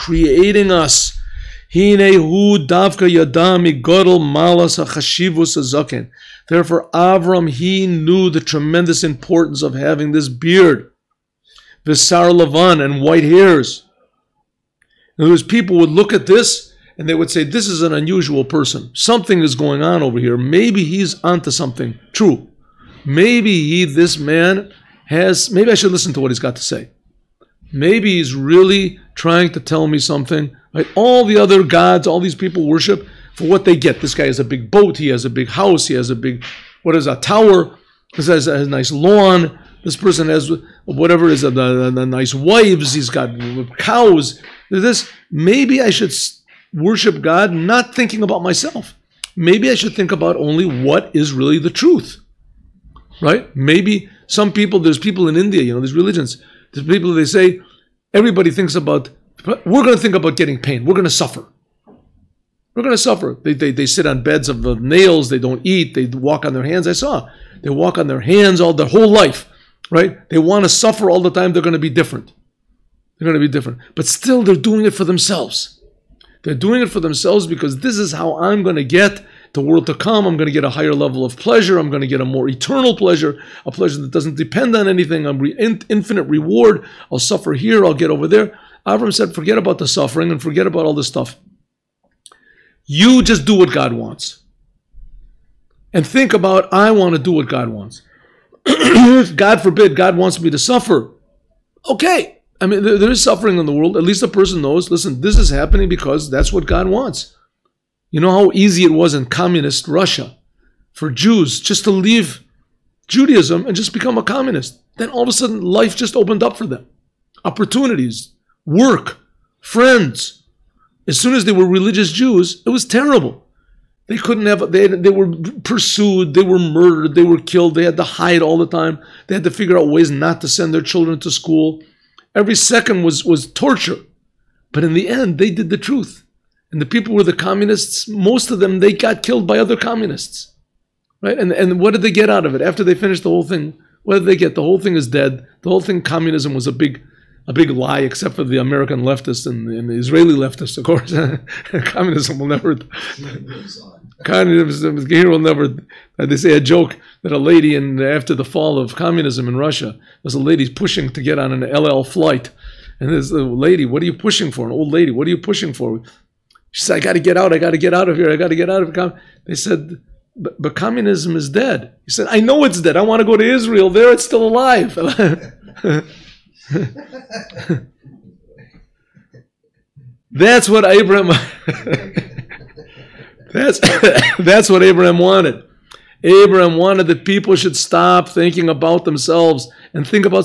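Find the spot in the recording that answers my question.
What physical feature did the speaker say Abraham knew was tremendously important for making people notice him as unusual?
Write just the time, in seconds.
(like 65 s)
10 s.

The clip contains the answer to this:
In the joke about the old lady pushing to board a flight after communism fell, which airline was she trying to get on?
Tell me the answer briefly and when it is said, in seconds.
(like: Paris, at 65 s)
El Al, at 161 s.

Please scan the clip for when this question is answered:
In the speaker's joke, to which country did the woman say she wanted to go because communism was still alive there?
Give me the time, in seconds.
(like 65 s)
173 s.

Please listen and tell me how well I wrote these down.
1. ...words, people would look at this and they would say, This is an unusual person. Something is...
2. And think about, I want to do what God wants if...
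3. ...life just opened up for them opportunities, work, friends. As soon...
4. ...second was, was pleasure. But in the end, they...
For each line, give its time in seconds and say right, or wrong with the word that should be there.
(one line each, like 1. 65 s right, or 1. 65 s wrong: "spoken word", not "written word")
1. 15 s right
2. 95 s right
3. 115 s right
4. 132 s wrong: "torture", not "pleasure".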